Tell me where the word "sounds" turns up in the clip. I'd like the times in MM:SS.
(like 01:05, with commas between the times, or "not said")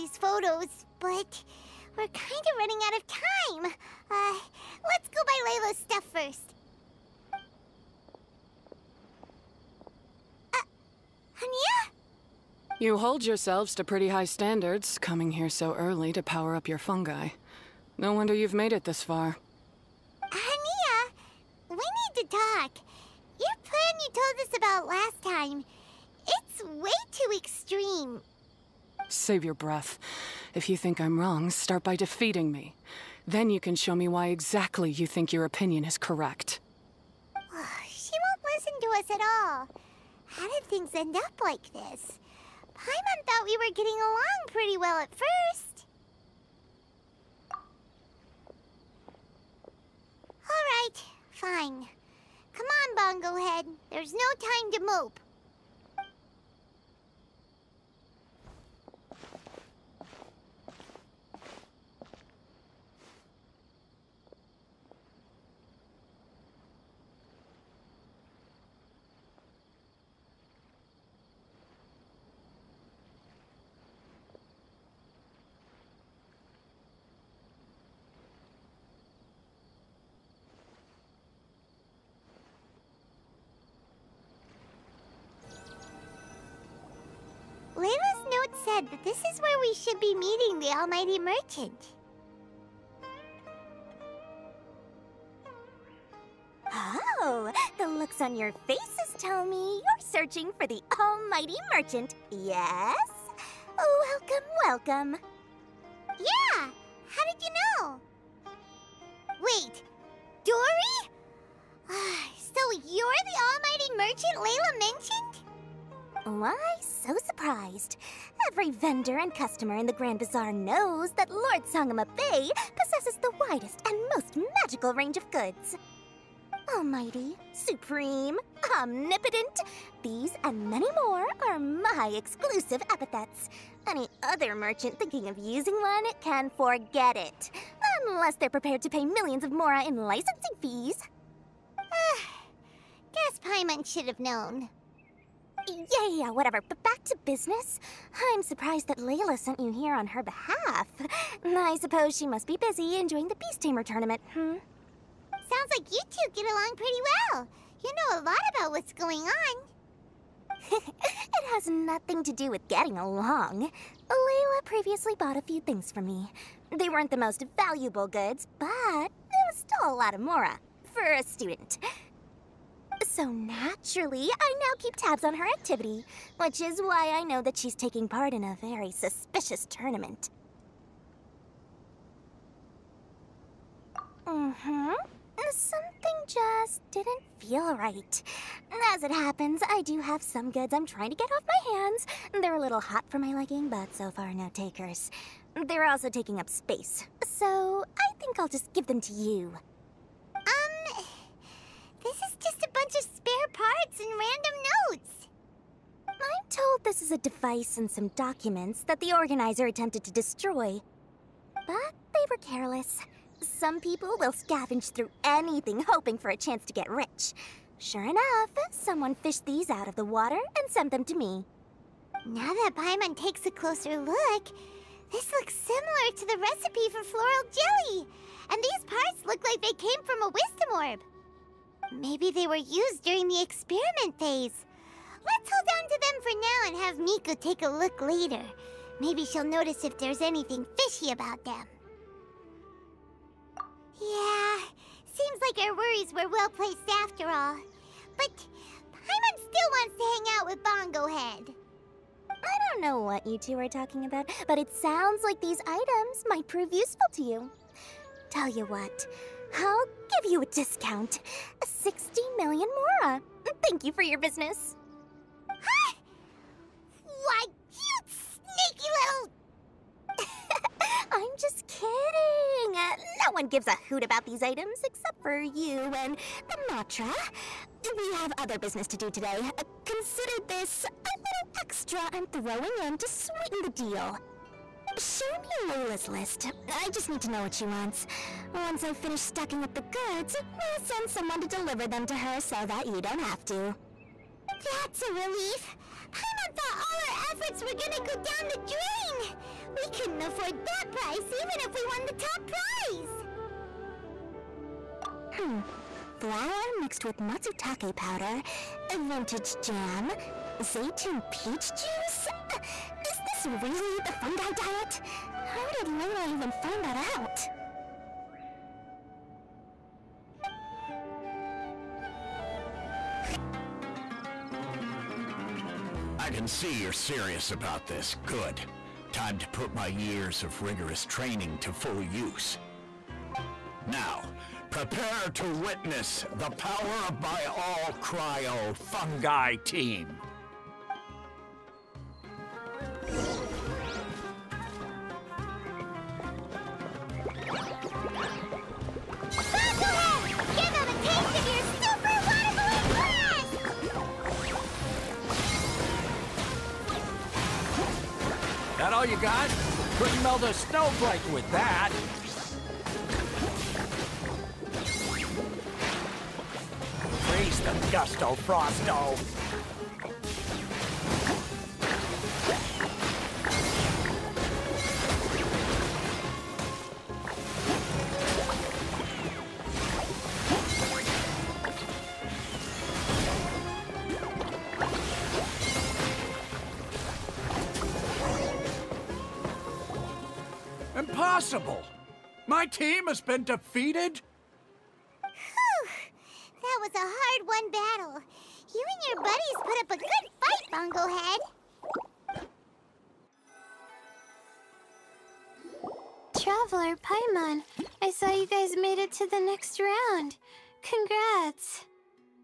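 02:35, 04:14.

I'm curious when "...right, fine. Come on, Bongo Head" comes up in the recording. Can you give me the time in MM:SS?
00:50.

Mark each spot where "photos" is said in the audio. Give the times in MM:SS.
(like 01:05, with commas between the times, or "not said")
00:00.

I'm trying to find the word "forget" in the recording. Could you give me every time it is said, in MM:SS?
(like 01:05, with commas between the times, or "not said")
02:16.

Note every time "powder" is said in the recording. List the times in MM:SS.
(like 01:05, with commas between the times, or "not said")
05:07.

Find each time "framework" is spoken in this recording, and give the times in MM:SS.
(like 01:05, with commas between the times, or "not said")
not said.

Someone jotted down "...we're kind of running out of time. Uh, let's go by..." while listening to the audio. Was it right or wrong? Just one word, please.
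right.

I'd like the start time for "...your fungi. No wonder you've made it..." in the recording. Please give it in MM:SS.
00:16.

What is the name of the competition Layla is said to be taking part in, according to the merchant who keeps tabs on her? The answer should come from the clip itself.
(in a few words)
Beast Tamer tournament.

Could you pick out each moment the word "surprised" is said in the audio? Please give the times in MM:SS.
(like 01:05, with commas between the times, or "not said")
01:57, 02:28.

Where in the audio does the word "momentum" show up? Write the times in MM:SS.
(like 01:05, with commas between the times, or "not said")
not said.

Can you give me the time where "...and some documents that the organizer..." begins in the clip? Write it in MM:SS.
03:27.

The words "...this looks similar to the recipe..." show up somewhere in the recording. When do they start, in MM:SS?
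03:45.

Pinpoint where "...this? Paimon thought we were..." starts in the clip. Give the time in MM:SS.
00:41.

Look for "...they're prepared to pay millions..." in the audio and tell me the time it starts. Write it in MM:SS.
02:18.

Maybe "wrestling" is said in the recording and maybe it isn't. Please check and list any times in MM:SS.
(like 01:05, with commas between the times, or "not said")
not said.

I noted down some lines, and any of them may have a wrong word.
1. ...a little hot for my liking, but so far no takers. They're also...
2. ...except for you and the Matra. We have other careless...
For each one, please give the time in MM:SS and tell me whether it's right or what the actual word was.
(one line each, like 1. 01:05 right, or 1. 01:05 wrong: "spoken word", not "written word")
1. 03:12 right
2. 04:34 wrong: "business", not "careless".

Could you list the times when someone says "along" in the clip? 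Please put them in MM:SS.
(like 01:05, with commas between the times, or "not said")
00:43, 02:36, 02:42.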